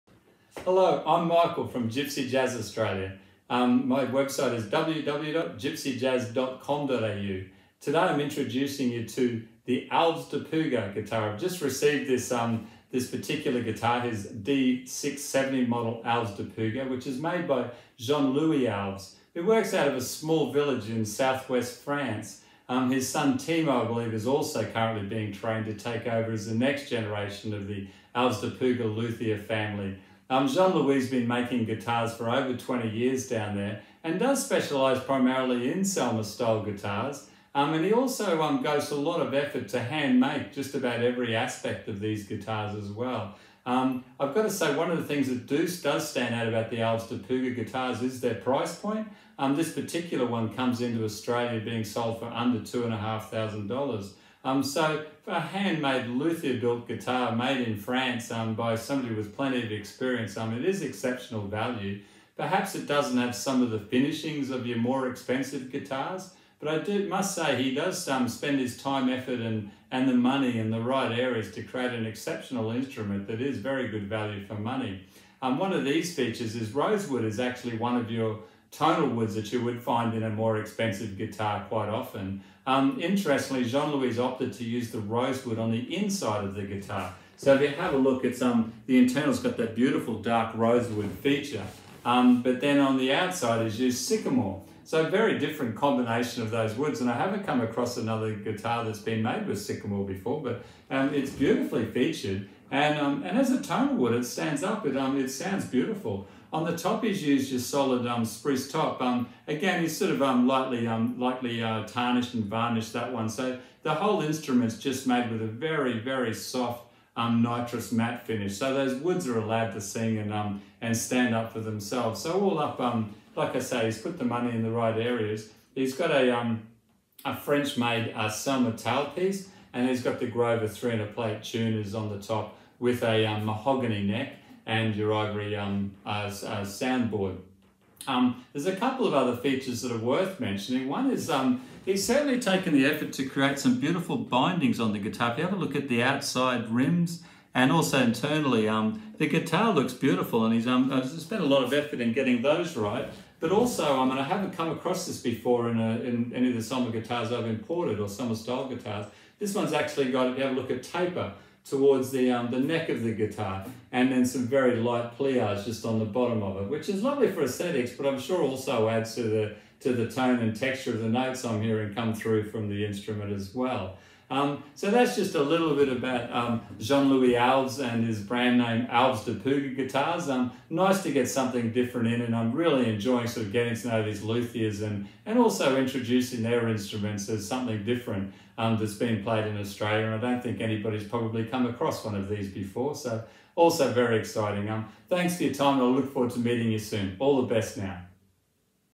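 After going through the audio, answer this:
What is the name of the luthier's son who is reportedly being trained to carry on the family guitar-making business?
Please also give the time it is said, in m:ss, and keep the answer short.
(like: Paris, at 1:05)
Timo, at 0:23.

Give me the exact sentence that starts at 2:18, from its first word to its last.
Um, there's a couple of other features that are worth mentioning.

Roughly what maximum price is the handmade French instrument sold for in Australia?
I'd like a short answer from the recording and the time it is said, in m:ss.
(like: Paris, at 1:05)
under $2,500, at 0:52.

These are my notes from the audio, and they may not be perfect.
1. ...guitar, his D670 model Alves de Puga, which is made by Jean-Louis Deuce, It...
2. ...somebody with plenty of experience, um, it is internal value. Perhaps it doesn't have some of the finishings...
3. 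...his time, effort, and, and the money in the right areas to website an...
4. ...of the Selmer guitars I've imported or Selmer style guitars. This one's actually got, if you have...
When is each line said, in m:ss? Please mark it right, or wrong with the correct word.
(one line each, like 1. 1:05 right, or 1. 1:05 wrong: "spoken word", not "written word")
1. 0:13 wrong: "Alves", not "Deuce"
2. 0:58 wrong: "exceptional", not "internal"
3. 1:08 wrong: "create", not "website"
4. 2:36 right.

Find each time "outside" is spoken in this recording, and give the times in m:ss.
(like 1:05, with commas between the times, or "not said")
1:33, 2:26.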